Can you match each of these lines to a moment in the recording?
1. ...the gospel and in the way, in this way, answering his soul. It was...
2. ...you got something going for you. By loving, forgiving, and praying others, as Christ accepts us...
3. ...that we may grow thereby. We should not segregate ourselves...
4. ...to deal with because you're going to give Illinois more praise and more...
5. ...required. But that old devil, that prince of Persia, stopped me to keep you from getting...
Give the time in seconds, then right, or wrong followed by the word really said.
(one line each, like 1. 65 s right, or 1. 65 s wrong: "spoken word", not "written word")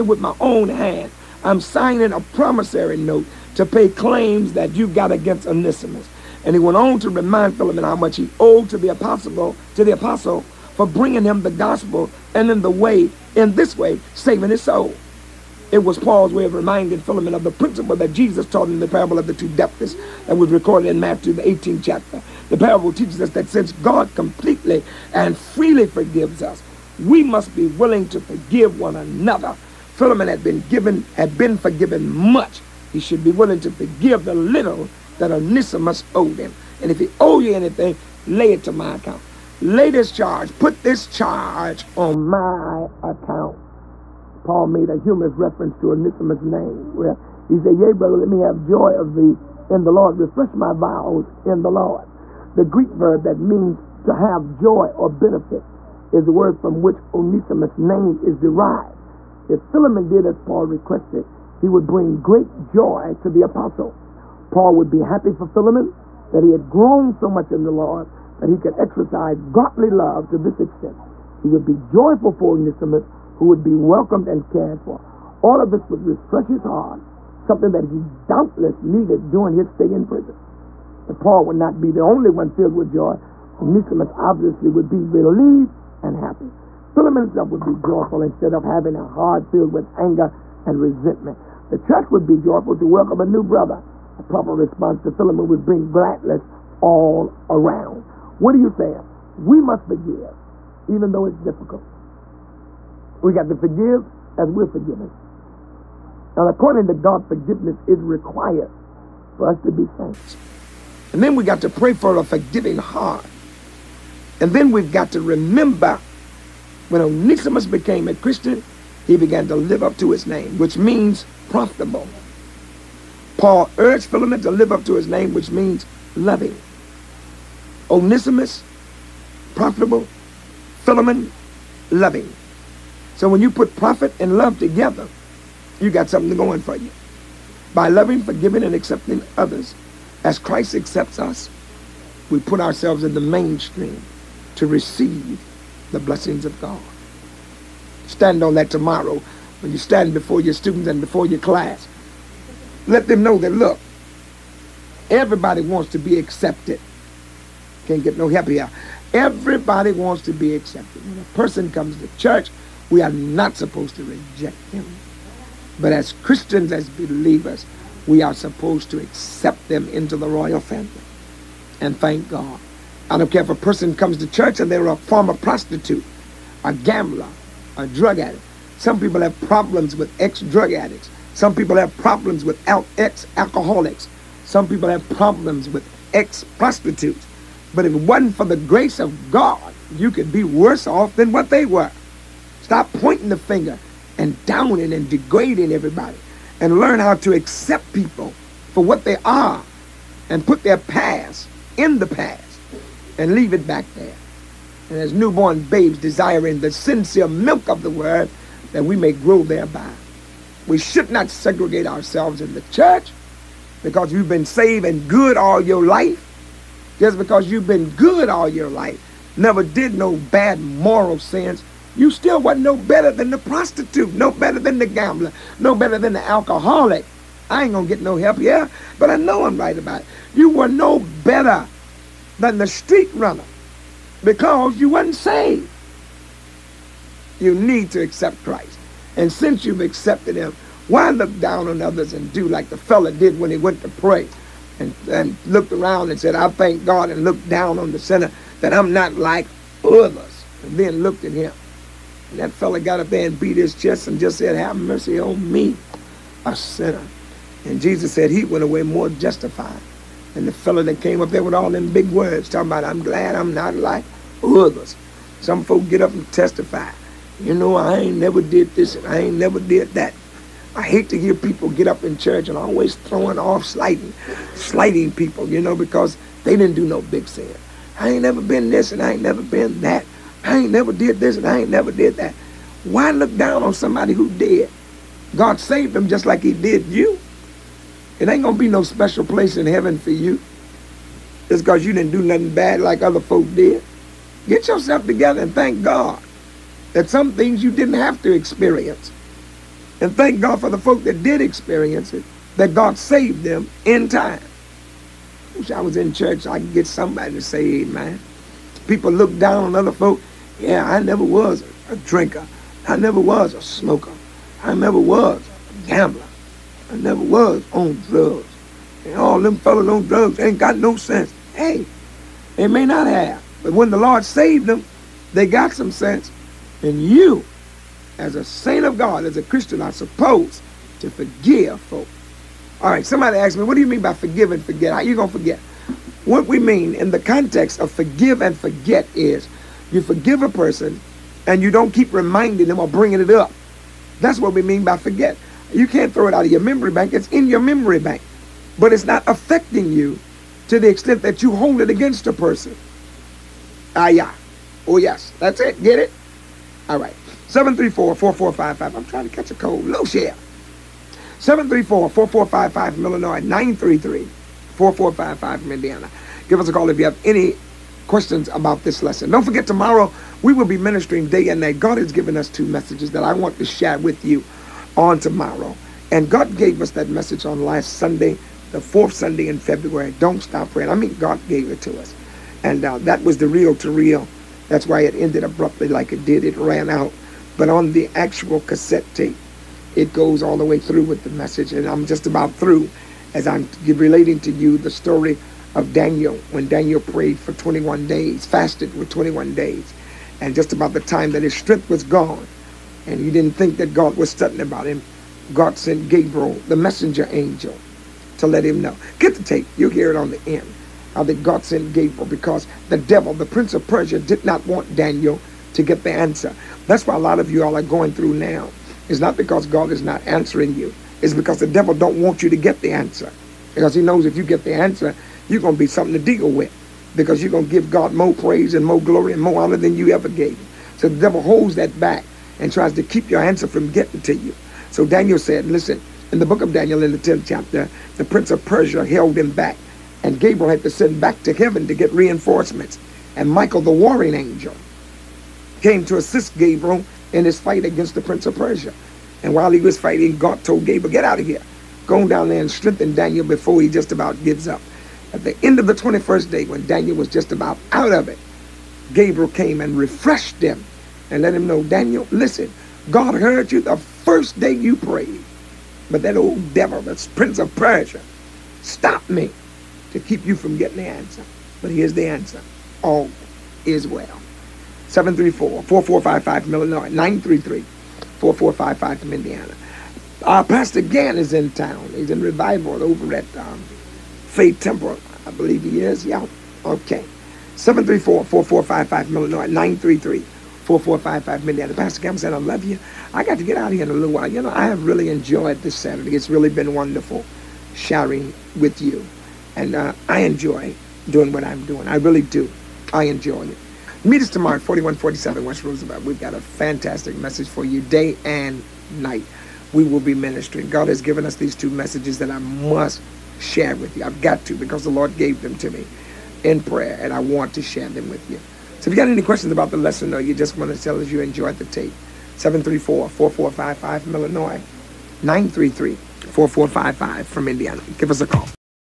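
1. 11 s wrong: "saving", not "answering"
2. 135 s wrong: "accepting", not "praying"
3. 208 s right
4. 426 s wrong: "God", not "Illinois"
5. 464 s wrong: "prayed", not "required".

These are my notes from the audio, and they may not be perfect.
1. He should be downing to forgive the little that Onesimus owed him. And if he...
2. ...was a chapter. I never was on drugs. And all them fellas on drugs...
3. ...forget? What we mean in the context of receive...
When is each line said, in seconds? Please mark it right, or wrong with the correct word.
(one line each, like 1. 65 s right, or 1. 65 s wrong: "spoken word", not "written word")
1. 32 s wrong: "willing", not "downing"
2. 314 s wrong: "gambler", not "chapter"
3. 335 s wrong: "forgive", not "receive".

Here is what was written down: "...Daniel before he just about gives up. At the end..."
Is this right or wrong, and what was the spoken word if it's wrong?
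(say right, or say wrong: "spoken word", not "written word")
right.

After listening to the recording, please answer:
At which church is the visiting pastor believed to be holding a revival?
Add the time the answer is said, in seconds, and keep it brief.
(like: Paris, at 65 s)
Faith Temple, at 484 s.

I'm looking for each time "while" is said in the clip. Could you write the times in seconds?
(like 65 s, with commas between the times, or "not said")
449 s, 494 s.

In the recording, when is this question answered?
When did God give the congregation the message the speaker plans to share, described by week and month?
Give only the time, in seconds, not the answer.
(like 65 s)
378 s.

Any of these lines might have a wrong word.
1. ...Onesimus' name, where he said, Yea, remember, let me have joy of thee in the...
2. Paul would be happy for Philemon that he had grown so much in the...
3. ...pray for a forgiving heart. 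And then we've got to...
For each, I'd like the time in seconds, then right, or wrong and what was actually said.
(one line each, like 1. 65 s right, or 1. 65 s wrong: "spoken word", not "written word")
1. 45 s wrong: "brother", not "remember"
2. 64 s right
3. 111 s right.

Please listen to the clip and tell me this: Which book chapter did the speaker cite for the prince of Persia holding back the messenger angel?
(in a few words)
10th chapter.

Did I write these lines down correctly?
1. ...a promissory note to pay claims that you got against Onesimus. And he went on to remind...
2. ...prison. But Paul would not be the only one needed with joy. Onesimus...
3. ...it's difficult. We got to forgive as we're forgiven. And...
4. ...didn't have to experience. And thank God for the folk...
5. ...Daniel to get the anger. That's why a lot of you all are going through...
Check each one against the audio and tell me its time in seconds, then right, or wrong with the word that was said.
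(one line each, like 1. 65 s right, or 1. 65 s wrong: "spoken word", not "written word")
1. 2 s right
2. 80 s wrong: "filled", not "needed"
3. 101 s right
4. 297 s right
5. 414 s wrong: "answer", not "anger".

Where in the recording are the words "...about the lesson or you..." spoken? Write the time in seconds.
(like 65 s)
519 s.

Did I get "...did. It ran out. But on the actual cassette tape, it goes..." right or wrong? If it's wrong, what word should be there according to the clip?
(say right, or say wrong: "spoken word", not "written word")
right.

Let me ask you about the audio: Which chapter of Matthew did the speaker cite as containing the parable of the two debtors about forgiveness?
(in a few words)
18th.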